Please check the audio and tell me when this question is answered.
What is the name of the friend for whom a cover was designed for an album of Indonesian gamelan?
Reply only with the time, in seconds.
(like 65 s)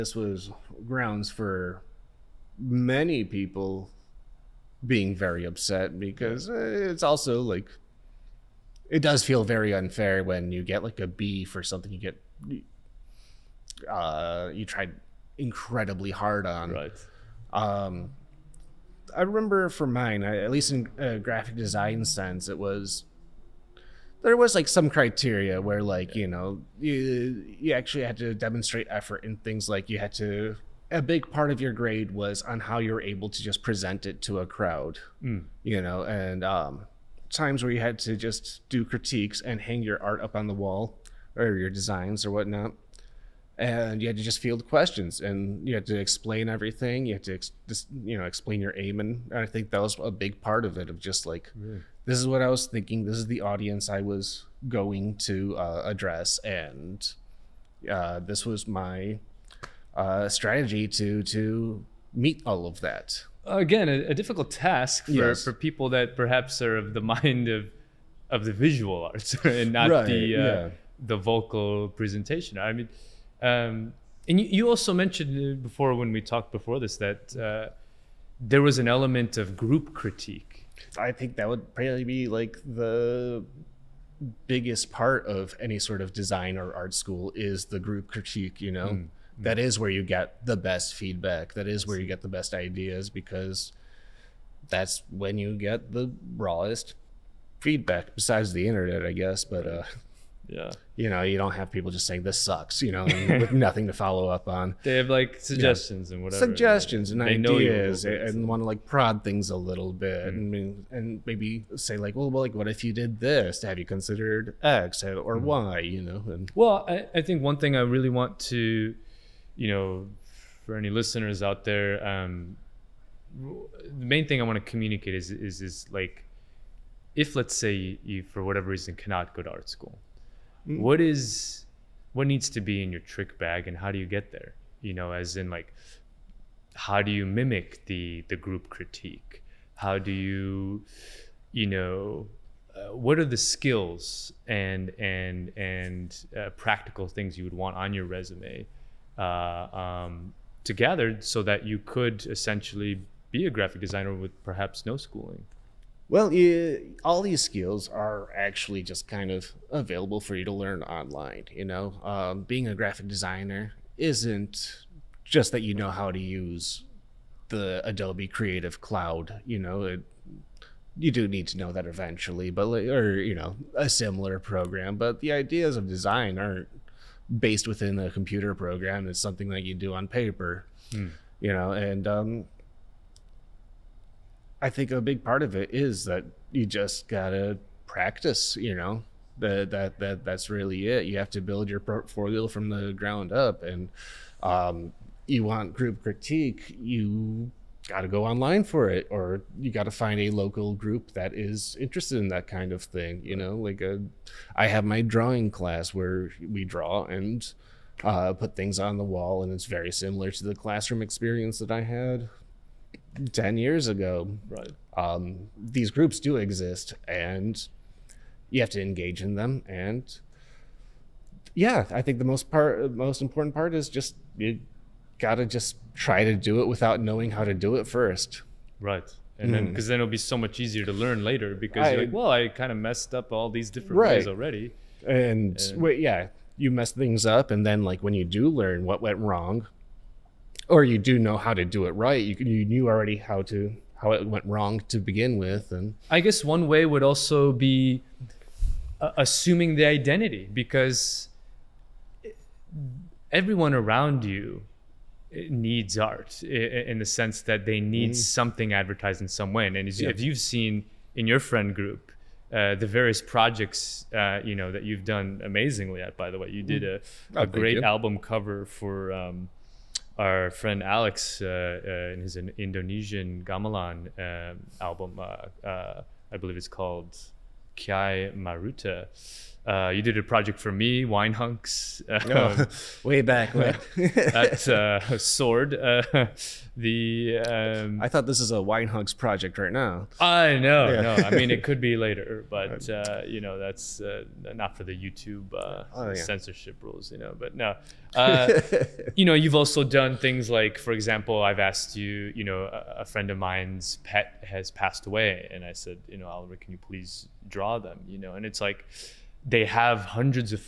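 270 s.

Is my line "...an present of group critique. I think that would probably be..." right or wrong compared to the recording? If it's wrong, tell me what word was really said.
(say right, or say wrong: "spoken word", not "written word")
wrong: "element", not "present".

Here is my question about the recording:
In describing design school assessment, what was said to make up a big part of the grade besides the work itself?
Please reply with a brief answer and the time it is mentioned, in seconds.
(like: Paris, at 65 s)
present it to a crowd, at 33 s.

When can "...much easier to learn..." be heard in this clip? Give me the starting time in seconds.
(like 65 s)
230 s.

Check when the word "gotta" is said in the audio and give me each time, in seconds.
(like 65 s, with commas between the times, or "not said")
187 s.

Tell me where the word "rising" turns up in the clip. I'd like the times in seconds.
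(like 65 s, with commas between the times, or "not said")
not said.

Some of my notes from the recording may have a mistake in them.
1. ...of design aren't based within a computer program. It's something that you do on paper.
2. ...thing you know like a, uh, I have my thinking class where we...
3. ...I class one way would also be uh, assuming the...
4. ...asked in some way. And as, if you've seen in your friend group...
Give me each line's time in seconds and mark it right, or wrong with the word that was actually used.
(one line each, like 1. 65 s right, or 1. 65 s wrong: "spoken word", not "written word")
1. 175 s right
2. 202 s wrong: "drawing", not "thinking"
3. 246 s wrong: "guess", not "class"
4. 258 s wrong: "advertised", not "asked".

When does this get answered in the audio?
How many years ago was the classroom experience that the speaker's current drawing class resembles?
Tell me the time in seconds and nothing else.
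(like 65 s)
213 s.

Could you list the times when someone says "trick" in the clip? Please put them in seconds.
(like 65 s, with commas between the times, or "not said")
133 s.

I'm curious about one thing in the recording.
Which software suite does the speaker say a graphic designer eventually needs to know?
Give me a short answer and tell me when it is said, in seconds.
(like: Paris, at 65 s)
Adobe Creative Cloud, at 167 s.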